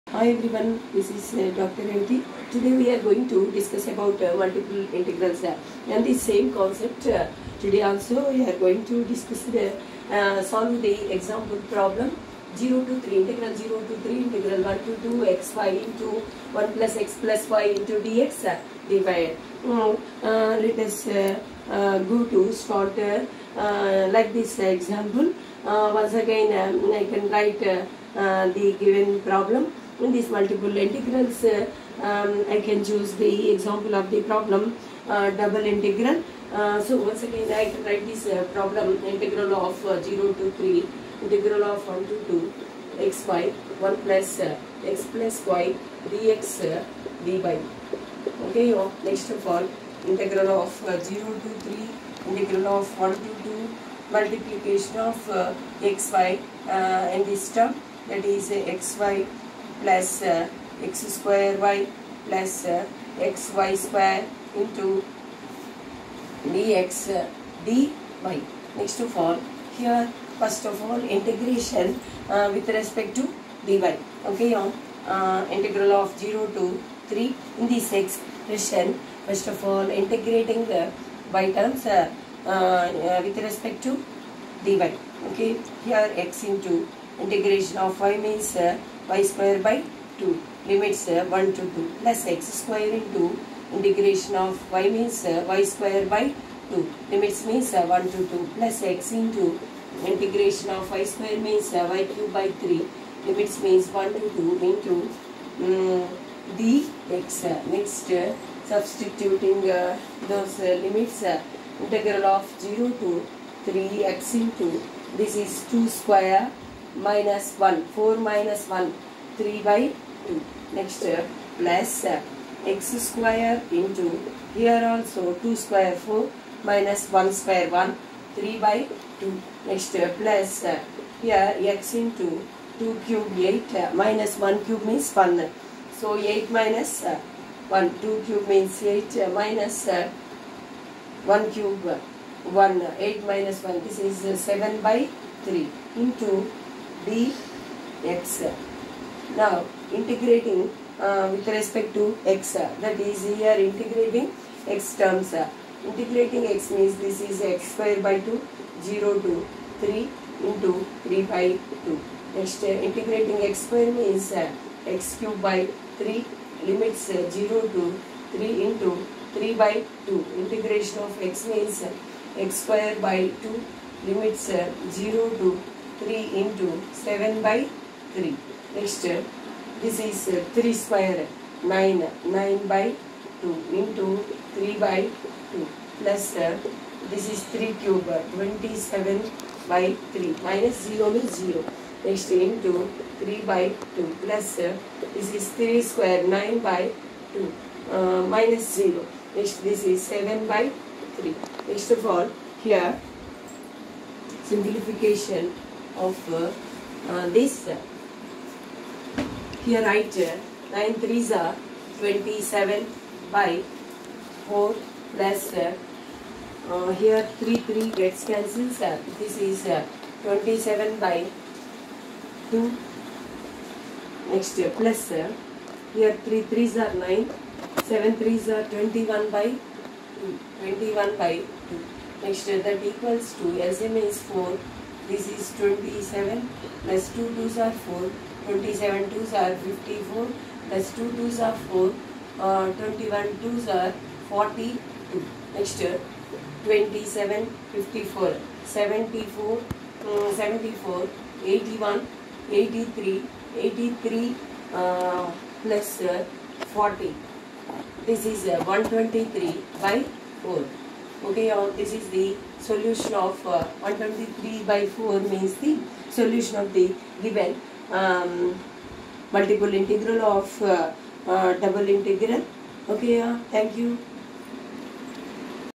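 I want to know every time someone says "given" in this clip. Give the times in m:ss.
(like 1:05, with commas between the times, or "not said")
0:28, 4:27.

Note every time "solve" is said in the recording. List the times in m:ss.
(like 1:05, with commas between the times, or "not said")
0:10.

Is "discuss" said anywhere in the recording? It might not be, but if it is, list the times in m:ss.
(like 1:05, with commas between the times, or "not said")
0:03, 0:09.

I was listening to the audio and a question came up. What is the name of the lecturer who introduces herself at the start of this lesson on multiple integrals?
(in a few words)
Dr. Revathi.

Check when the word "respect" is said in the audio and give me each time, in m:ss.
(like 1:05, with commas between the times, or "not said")
1:12, 1:23, 2:31.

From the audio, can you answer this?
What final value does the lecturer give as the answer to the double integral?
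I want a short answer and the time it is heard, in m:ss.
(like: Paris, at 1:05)
123/4, at 4:23.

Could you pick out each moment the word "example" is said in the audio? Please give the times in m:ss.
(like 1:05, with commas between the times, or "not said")
0:11, 0:24, 0:33.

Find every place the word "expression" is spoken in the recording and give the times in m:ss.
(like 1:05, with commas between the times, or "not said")
1:17.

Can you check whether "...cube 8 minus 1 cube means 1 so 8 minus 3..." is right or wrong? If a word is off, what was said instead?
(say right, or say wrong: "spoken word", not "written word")
wrong: "1", not "3".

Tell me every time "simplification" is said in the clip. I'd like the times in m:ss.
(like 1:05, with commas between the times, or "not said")
3:24.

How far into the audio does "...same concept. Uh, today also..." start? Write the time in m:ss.
0:06.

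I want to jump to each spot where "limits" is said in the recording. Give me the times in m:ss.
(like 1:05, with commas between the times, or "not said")
1:30, 1:37, 1:43, 1:50, 2:46, 2:54.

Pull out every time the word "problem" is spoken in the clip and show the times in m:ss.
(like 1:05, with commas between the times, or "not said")
0:11, 0:29, 0:34, 0:38.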